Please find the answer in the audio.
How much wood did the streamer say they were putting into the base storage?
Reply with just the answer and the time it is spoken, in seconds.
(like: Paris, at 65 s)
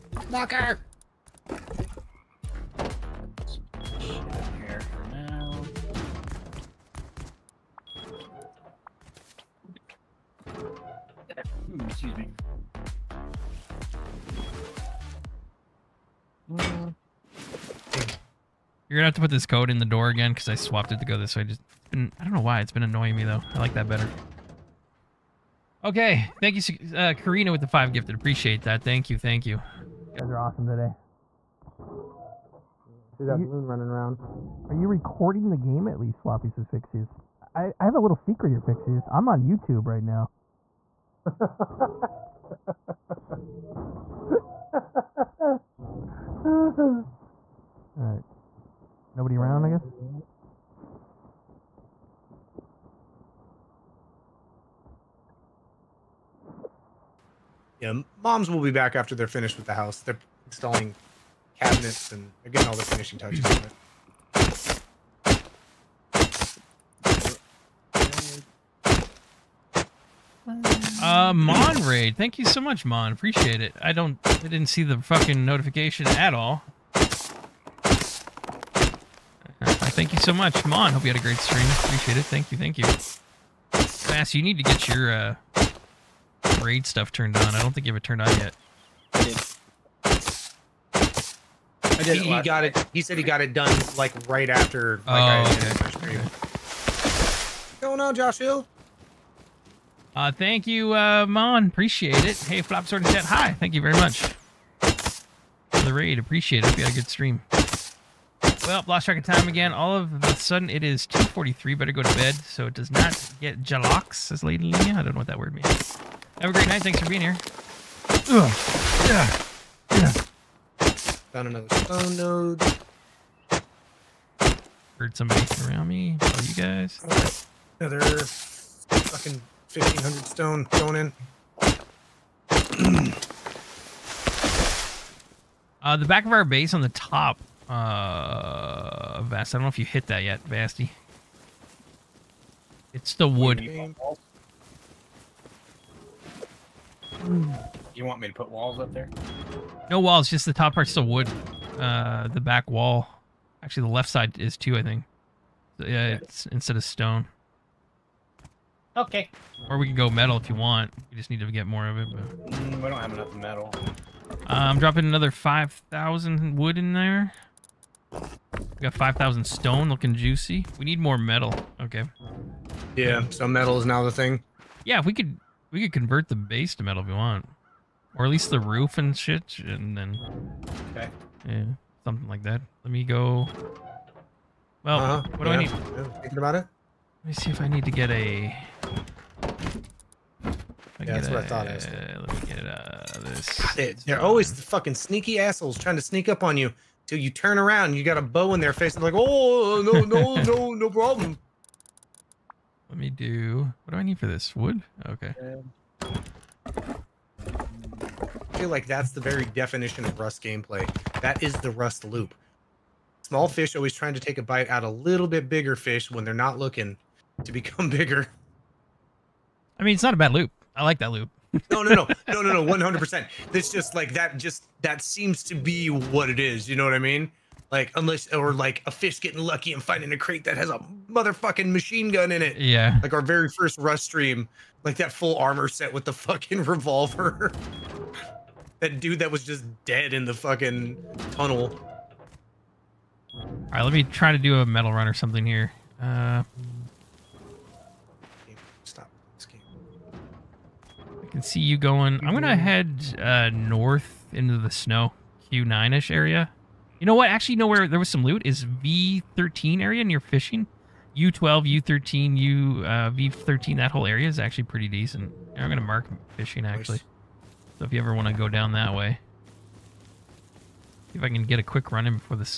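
5,000, at 165 s.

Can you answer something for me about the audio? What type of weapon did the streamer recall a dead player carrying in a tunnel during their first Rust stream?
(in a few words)
Revolver.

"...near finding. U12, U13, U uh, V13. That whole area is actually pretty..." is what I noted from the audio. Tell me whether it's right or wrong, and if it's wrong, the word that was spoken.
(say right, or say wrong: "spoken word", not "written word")
wrong: "fishing", not "finding".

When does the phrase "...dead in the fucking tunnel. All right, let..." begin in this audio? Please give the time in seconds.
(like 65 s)
239 s.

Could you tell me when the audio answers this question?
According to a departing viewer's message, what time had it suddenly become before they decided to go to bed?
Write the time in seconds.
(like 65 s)
111 s.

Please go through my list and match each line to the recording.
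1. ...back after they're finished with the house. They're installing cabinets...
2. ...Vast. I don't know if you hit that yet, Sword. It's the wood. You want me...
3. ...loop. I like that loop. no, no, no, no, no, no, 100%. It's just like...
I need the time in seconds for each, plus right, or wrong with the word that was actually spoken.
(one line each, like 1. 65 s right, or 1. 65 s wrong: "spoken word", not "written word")
1. 58 s right
2. 139 s wrong: "Vasty", not "Sword"
3. 220 s right.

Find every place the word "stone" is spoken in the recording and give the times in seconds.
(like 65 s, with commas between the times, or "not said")
121 s, 130 s, 156 s, 169 s.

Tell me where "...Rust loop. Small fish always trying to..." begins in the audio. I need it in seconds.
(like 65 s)
211 s.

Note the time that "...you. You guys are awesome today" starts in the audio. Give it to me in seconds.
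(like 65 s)
29 s.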